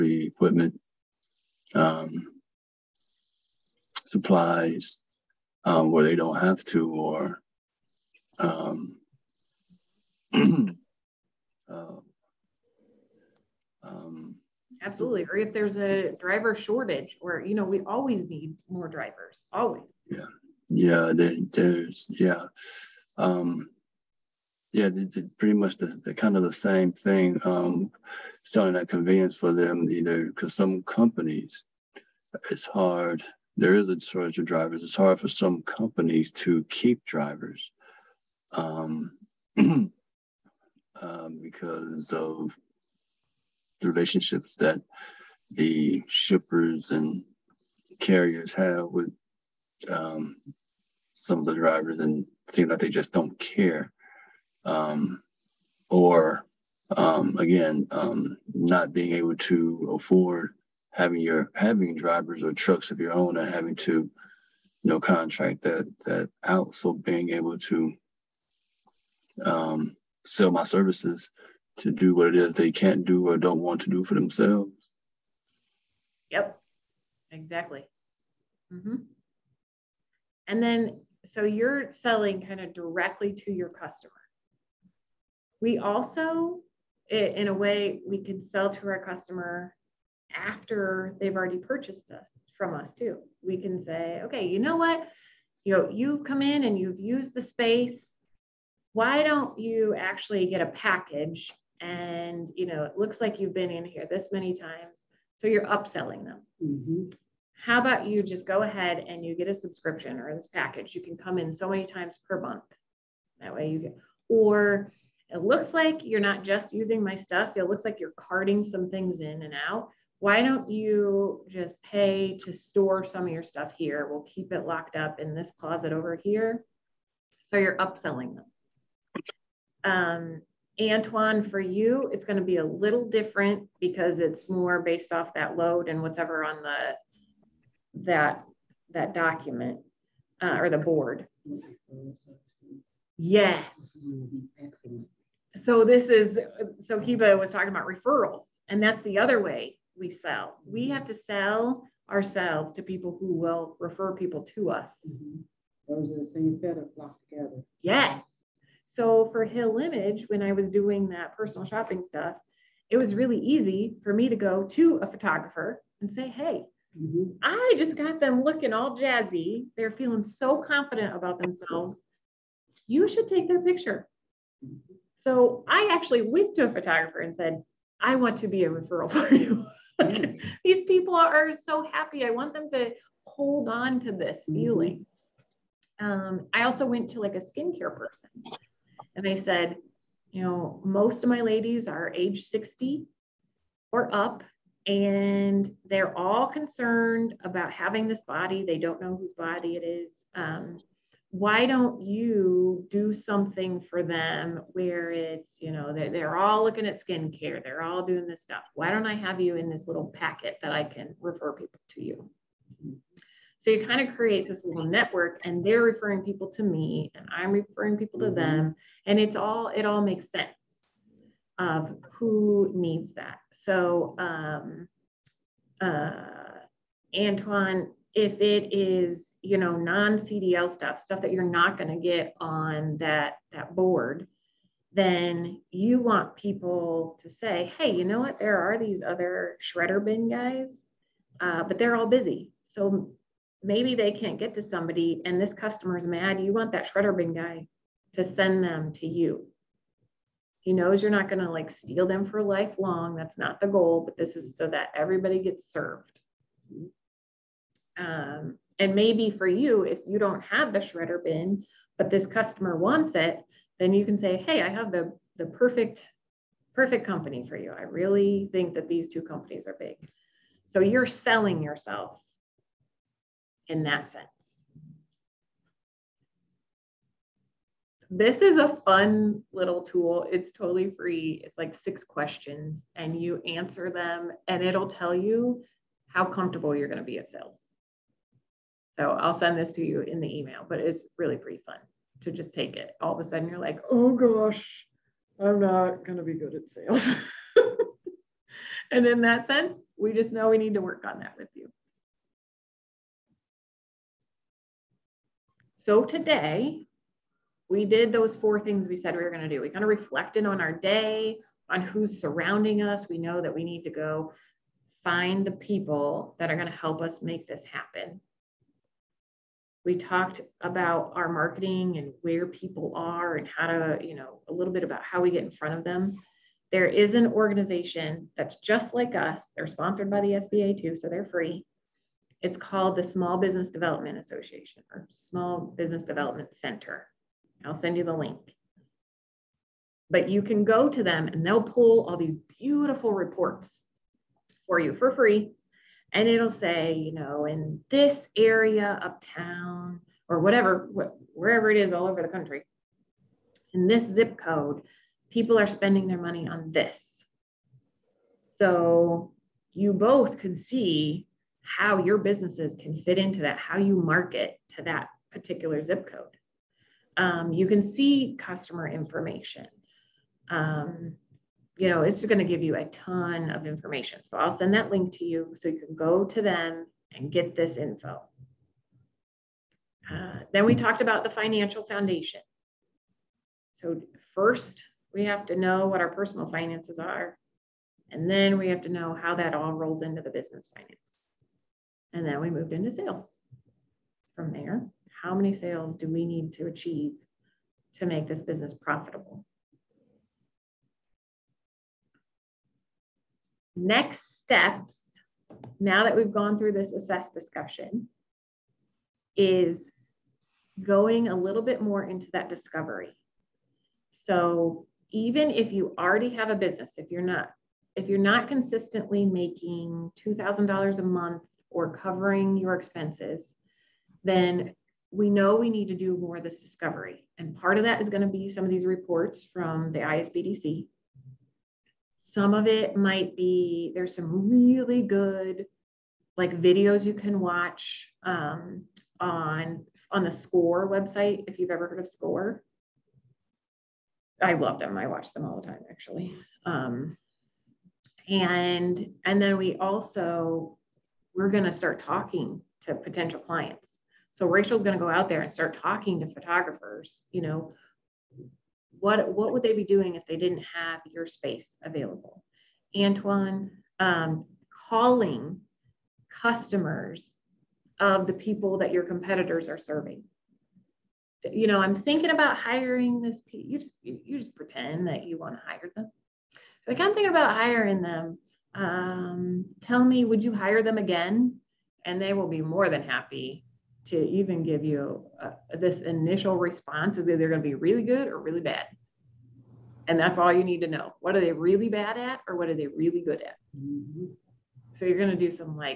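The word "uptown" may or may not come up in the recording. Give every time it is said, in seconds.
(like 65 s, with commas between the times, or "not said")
349 s.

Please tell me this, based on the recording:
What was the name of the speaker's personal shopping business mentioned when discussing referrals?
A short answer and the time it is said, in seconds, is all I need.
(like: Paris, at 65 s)
Hill Image, at 159 s.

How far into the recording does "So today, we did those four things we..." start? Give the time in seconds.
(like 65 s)
305 s.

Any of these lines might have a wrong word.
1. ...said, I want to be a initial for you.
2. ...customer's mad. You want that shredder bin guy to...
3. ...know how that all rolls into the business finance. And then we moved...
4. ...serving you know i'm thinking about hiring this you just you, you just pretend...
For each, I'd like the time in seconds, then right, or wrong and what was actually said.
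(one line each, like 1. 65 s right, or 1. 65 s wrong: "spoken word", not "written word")
1. 177 s wrong: "referral", not "initial"
2. 245 s right
3. 388 s right
4. 469 s right.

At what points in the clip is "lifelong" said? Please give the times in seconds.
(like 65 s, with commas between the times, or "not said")
252 s.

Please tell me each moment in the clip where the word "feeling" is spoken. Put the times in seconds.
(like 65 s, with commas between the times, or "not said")
169 s, 184 s.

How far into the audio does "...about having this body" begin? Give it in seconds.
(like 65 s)
197 s.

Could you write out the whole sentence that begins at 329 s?
They're sponsored by the SBA too, so they're free.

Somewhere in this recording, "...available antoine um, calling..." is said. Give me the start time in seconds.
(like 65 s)
461 s.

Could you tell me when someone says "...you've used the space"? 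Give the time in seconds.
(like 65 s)
96 s.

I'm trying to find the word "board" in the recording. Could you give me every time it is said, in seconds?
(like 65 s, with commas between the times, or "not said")
140 s, 233 s.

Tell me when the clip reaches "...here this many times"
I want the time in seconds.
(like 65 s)
103 s.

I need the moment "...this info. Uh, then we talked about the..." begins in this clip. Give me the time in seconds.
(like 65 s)
377 s.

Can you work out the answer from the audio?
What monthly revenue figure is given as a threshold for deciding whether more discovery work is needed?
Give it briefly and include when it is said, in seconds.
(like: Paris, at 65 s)
$2,000, at 420 s.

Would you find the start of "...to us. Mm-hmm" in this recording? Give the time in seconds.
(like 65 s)
154 s.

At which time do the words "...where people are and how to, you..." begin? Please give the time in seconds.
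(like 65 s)
322 s.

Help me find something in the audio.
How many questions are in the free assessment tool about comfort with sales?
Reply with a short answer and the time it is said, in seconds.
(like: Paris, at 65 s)
6, at 281 s.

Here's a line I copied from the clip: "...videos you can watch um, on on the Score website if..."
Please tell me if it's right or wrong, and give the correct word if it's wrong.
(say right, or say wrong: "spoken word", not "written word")
right.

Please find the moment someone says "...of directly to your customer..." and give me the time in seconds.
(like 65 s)
82 s.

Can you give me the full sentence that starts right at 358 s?
So you both can see how your businesses can fit into that, how you market to that particular zip code.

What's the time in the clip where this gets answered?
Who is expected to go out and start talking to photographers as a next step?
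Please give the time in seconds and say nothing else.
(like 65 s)
454 s.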